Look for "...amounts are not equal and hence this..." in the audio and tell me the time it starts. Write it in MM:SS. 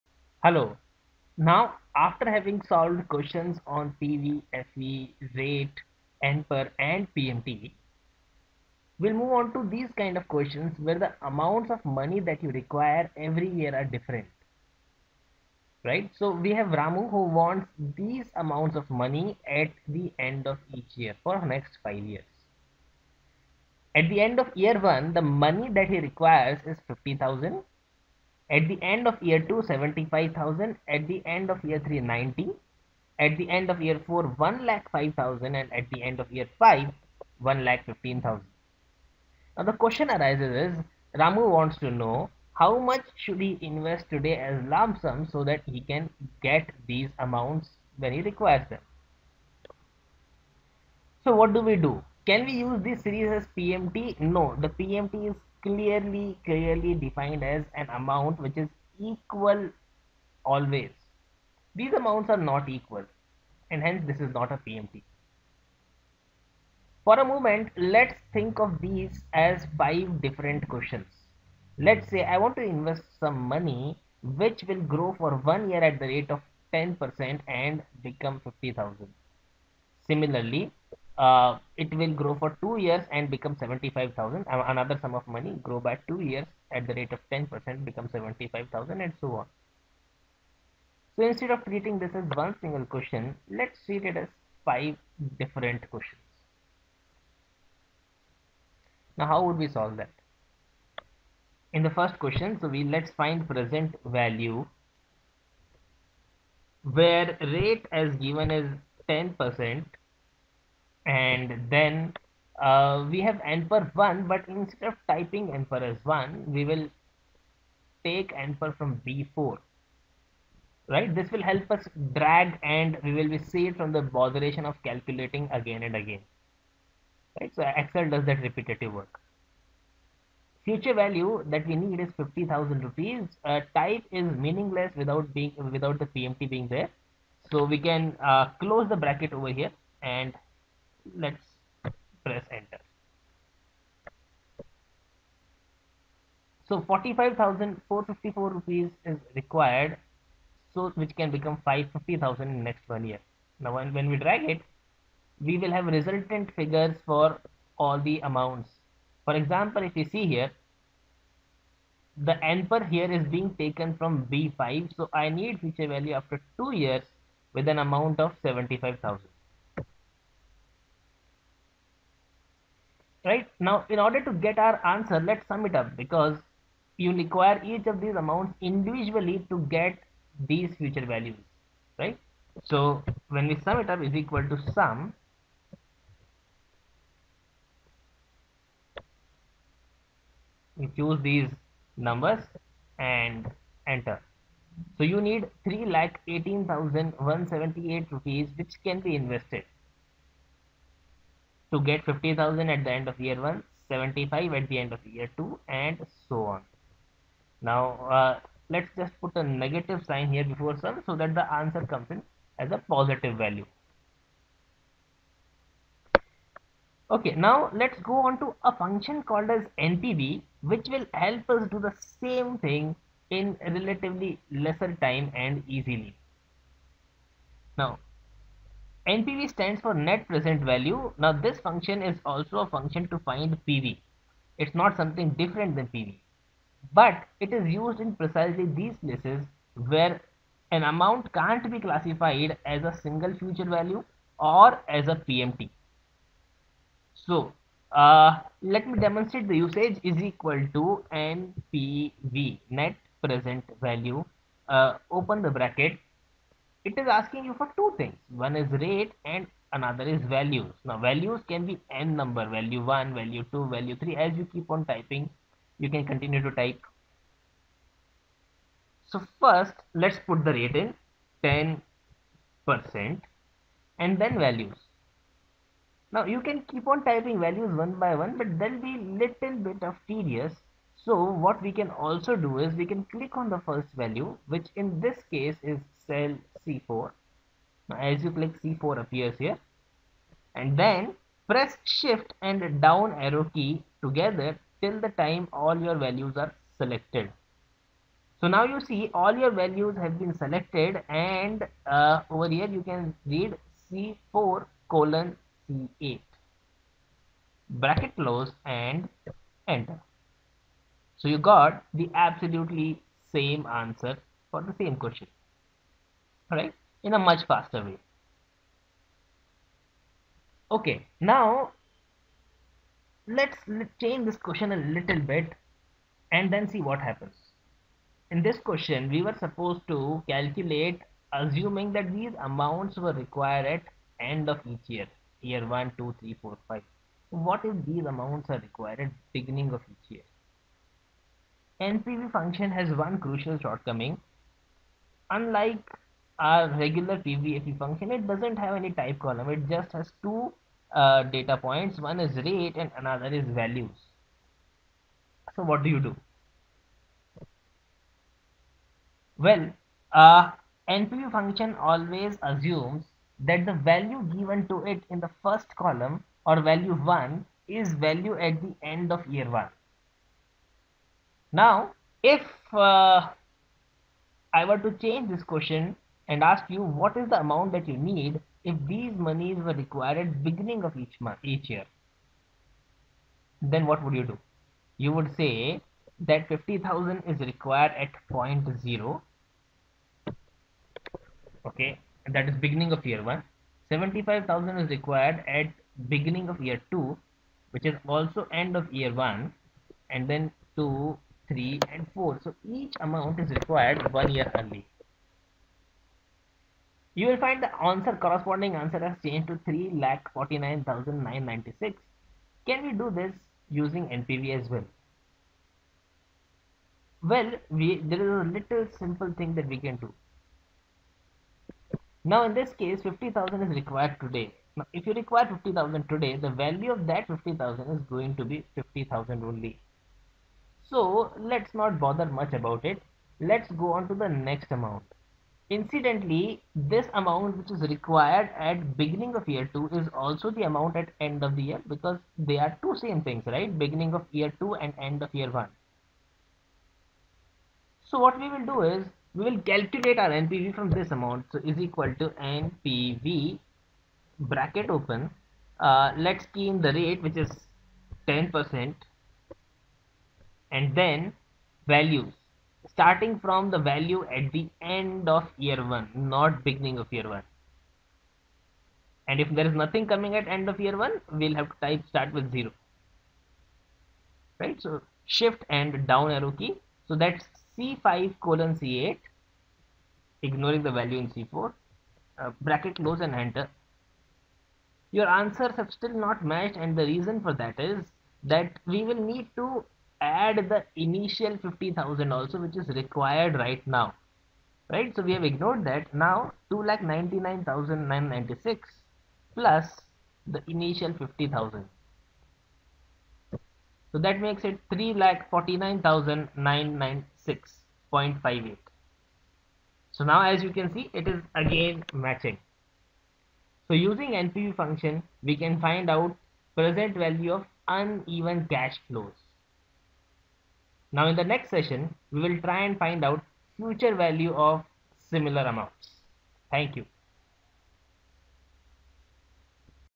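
01:01.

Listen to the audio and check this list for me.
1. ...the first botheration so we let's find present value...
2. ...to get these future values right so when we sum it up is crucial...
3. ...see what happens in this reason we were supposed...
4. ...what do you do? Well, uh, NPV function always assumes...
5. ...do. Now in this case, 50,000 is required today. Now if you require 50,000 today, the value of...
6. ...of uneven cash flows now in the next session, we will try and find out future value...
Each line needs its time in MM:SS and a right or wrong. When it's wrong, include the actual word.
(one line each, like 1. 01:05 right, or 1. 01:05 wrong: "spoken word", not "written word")
1. 01:41 wrong: "question", not "botheration"
2. 02:59 wrong: "equal", not "crucial"
3. 05:26 wrong: "question", not "reason"
4. 05:55 right
5. 06:59 right
6. 08:37 right.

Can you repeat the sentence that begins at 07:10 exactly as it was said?
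So let's not bother much about it.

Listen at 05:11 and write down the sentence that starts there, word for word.
So you got the absolutely same answer for the same question.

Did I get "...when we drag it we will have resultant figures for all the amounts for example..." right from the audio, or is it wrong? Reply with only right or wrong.
right.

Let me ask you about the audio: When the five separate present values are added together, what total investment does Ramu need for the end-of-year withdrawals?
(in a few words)
3 lakh 18,178 rupees.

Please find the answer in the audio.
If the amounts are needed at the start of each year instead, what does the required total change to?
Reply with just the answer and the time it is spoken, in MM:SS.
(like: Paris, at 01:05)
3,49,996, at 06:49.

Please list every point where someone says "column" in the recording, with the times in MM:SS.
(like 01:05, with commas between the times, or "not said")
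05:49, 06:05.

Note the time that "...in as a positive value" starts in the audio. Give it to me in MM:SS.
03:32.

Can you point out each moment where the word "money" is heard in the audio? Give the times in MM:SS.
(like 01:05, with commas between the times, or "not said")
00:11, 00:18, 00:25, 01:13, 01:25.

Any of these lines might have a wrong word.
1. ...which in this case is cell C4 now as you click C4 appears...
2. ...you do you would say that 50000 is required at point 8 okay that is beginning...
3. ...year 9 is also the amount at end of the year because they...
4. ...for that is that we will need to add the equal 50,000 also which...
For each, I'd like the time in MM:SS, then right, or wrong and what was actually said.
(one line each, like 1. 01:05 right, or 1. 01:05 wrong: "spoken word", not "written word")
1. 04:44 right
2. 06:24 wrong: "0", not "8"
3. 07:19 wrong: "2", not "9"
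4. 08:07 wrong: "initial", not "equal".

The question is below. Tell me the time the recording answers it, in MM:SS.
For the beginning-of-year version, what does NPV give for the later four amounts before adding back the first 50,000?
08:16.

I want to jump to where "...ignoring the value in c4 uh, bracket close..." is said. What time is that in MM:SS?
08:00.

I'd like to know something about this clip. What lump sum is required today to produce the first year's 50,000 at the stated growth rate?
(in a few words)
45,454 rupees.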